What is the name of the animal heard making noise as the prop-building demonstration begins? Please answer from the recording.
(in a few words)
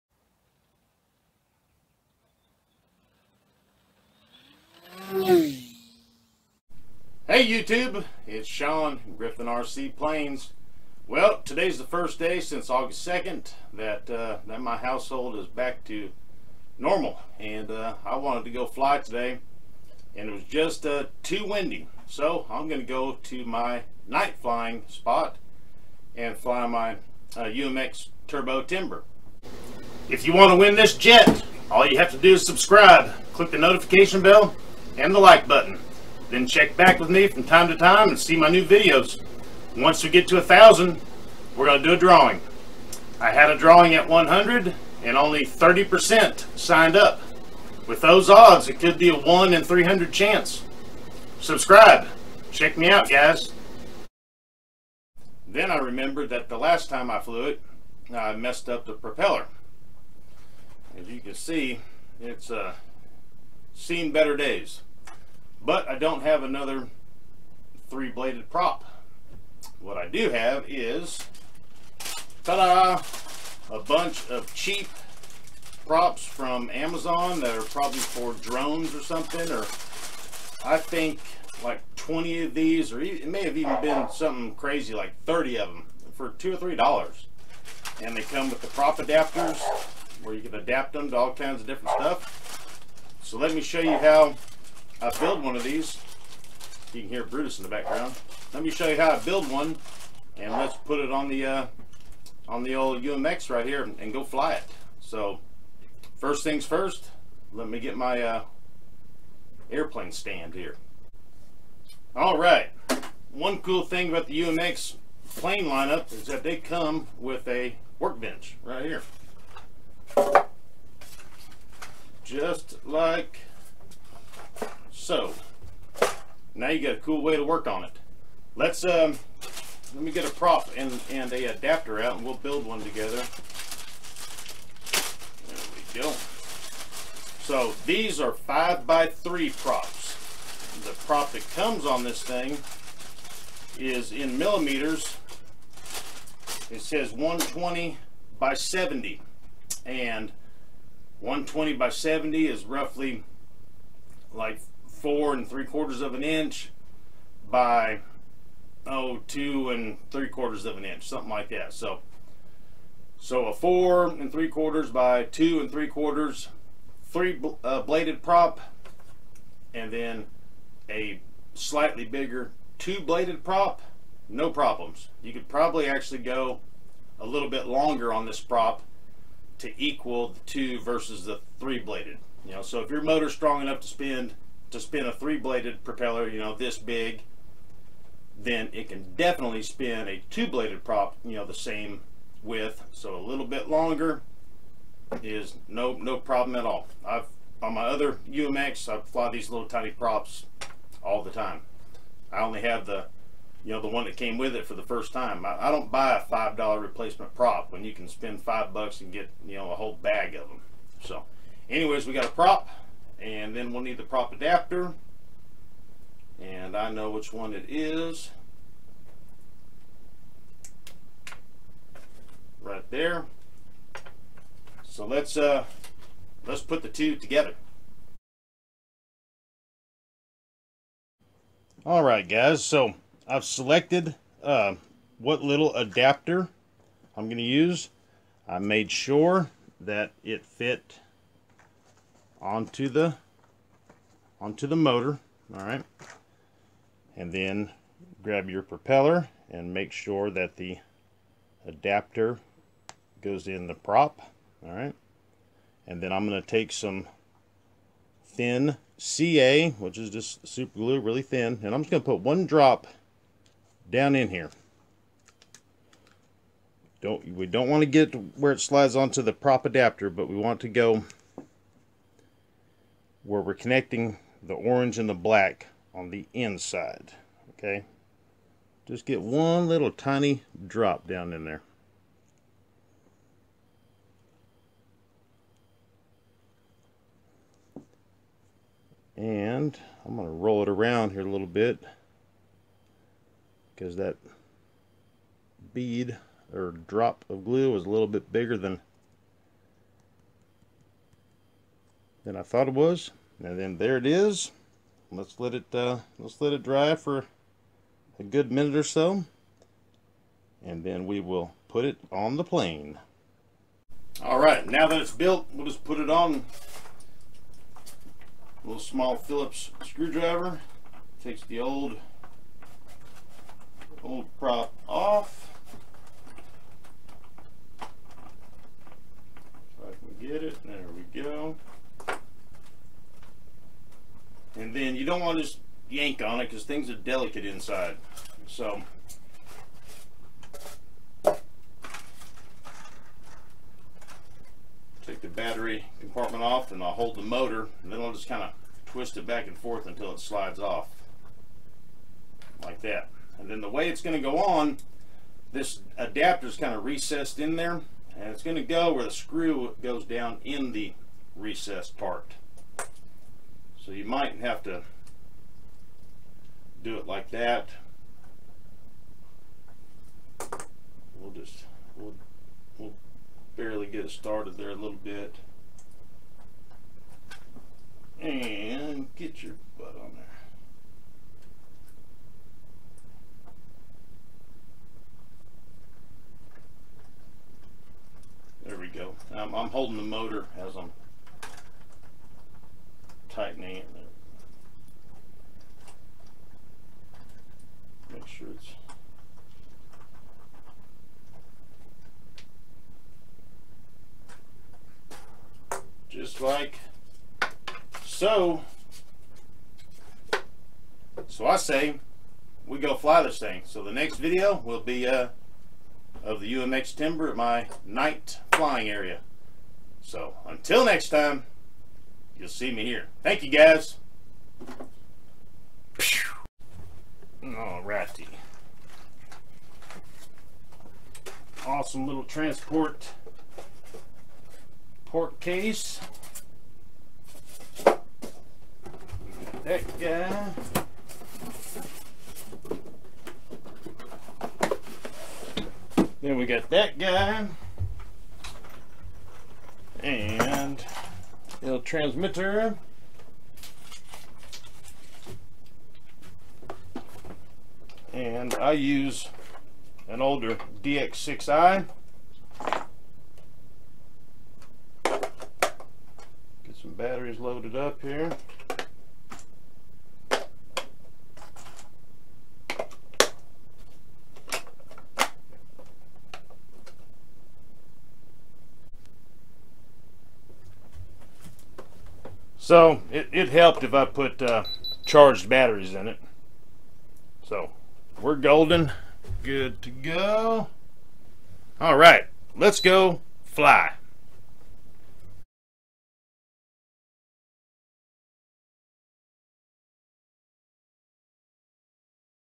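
Brutus.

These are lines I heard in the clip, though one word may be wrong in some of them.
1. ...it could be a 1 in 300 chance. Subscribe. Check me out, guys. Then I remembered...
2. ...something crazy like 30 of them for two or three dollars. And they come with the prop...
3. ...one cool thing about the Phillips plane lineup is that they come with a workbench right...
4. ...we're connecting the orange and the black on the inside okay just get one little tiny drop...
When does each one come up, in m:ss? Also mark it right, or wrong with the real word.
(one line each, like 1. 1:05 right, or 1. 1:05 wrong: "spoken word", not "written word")
1. 0:48 right
2. 1:24 right
3. 1:53 wrong: "UMX", not "Phillips"
4. 4:33 right.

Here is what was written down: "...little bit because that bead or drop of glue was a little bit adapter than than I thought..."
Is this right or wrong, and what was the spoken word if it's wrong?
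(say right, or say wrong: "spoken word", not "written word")
wrong: "bigger", not "adapter".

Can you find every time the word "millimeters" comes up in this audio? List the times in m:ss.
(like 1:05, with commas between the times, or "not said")
2:24.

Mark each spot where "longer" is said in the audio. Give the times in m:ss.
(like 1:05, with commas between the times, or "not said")
2:57, 3:13.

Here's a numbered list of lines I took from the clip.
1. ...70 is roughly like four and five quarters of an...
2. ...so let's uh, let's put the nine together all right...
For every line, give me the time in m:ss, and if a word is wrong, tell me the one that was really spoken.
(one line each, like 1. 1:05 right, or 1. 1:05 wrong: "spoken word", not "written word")
1. 2:31 wrong: "three", not "five"
2. 3:44 wrong: "two", not "nine".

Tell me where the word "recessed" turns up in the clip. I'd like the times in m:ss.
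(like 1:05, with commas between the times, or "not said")
5:56, 6:01.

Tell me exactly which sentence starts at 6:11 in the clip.
We'll just, we'll, we'll barely get it started there a little bit.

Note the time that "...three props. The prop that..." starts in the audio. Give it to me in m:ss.
2:19.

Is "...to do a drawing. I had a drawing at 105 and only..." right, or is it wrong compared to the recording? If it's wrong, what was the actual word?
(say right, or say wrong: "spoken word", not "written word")
wrong: "100", not "105".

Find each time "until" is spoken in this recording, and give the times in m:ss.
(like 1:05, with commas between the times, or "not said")
5:49, 7:00.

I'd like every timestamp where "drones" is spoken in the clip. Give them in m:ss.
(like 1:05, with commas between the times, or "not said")
1:18.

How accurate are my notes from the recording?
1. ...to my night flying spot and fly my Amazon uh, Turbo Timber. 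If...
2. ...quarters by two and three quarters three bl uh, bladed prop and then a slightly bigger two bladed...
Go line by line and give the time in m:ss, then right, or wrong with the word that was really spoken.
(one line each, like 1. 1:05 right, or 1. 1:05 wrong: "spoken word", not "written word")
1. 0:23 wrong: "UMX", not "Amazon"
2. 2:44 right.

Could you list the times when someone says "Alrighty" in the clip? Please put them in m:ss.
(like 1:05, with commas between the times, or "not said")
7:07.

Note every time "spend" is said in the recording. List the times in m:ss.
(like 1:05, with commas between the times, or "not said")
3:03, 3:28.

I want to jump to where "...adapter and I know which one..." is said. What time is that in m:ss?
3:34.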